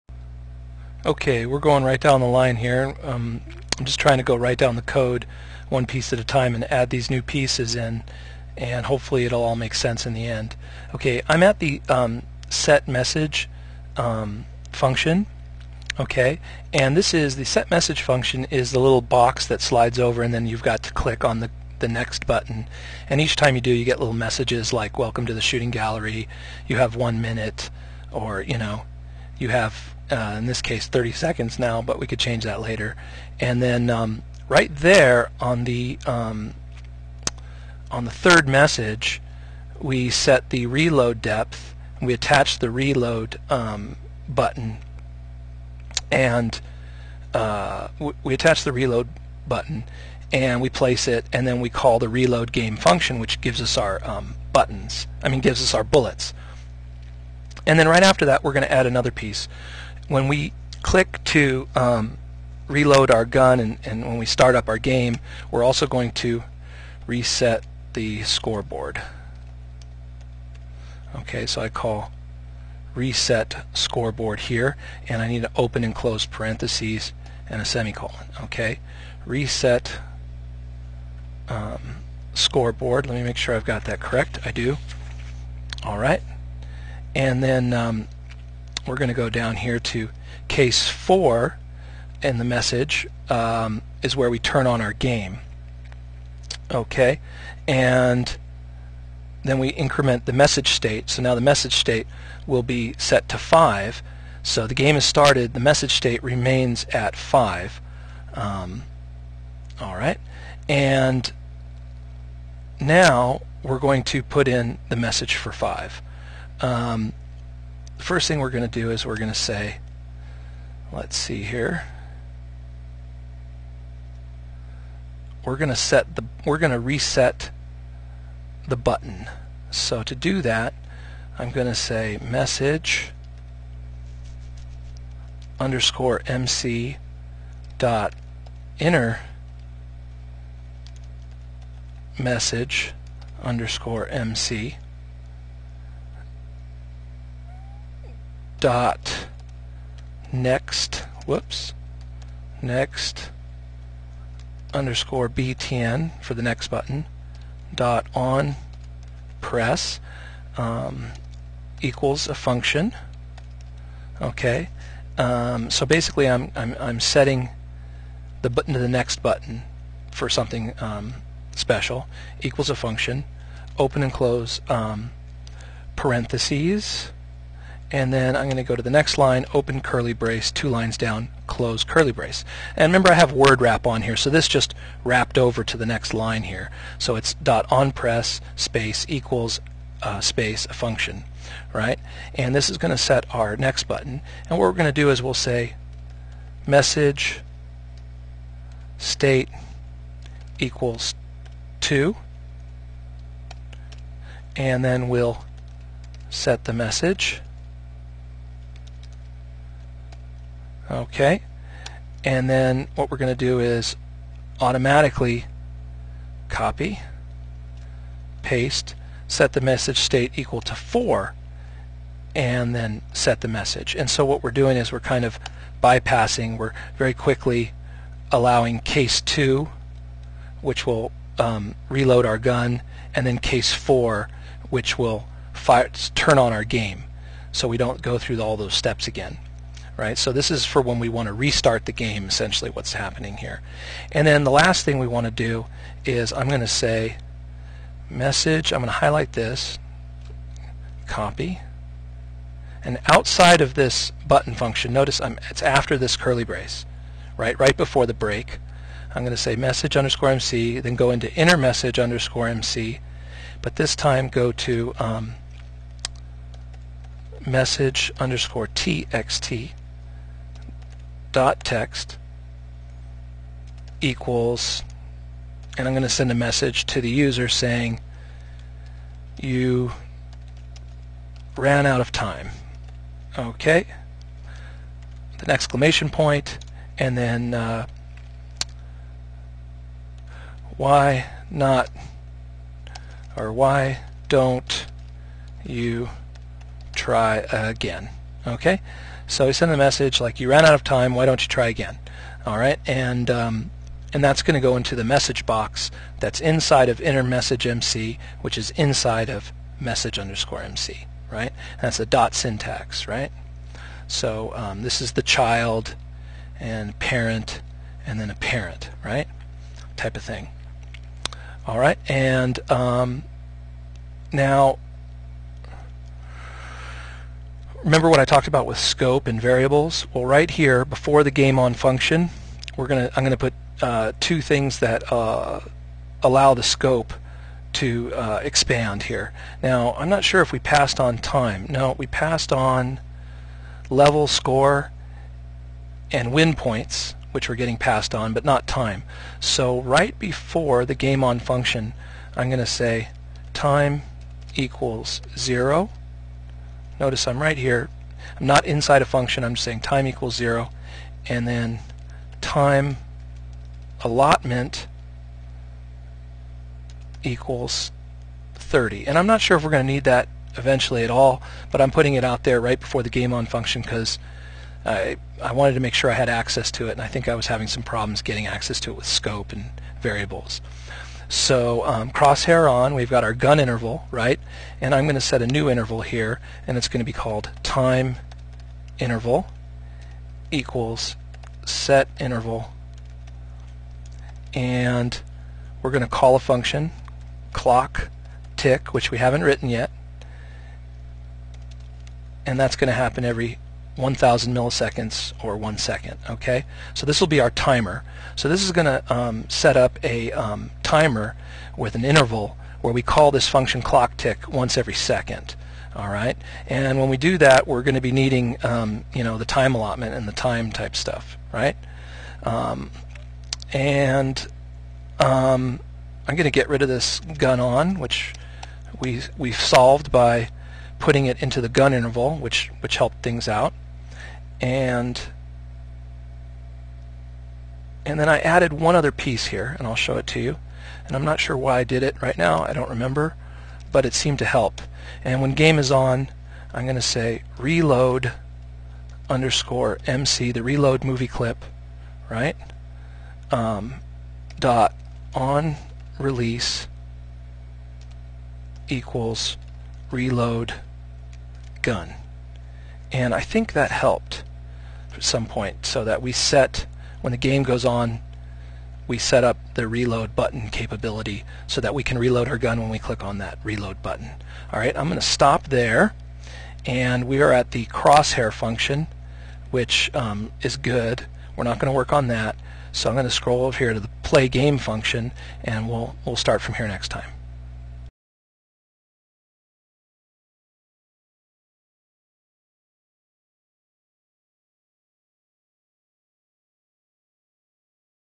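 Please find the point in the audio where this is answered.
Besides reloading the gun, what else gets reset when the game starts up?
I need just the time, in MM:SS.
01:07.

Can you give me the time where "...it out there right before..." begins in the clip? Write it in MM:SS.
06:12.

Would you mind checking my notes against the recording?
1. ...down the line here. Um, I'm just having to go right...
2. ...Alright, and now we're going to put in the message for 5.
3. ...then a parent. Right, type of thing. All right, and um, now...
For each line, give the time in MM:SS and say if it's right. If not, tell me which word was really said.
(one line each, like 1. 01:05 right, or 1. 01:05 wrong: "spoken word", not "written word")
1. 00:01 wrong: "trying", not "having"
2. 01:49 right
3. 05:18 right.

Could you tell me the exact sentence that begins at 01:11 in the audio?
Okay, so I call reset scoreboard here, and I need to open and close parentheses and a semicolon.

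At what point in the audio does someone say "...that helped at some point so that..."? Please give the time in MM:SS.
07:43.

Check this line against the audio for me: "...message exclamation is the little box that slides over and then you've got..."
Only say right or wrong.
wrong.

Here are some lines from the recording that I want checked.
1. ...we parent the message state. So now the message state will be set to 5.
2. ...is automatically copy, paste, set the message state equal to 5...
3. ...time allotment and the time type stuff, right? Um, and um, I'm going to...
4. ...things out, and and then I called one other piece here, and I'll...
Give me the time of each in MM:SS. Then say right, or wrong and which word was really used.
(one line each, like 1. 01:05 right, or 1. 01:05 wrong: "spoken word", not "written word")
1. 01:39 wrong: "increment", not "parent"
2. 03:33 wrong: "4", not "5"
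3. 06:59 right
4. 07:13 wrong: "added", not "called".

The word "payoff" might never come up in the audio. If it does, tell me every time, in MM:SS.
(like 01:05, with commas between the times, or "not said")
not said.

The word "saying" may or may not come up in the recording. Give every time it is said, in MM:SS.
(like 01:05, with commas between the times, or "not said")
04:37, 05:59.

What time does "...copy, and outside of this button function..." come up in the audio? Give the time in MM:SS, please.
04:11.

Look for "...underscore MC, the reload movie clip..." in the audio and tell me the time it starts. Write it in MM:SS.
07:29.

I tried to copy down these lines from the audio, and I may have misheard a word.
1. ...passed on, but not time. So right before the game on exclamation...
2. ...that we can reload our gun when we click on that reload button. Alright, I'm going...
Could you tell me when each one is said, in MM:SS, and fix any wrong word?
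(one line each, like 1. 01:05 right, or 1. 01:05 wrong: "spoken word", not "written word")
1. 05:47 wrong: "function", not "exclamation"
2. 07:51 right.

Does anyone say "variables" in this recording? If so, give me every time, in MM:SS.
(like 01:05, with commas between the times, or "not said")
05:29, 06:20.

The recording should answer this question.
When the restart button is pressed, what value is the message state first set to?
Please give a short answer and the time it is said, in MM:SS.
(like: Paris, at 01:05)
2, at 03:16.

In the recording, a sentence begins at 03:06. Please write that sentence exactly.
So it's dot on press space equals uh, space a function, right?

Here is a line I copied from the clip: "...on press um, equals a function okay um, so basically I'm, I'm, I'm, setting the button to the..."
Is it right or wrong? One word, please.
right.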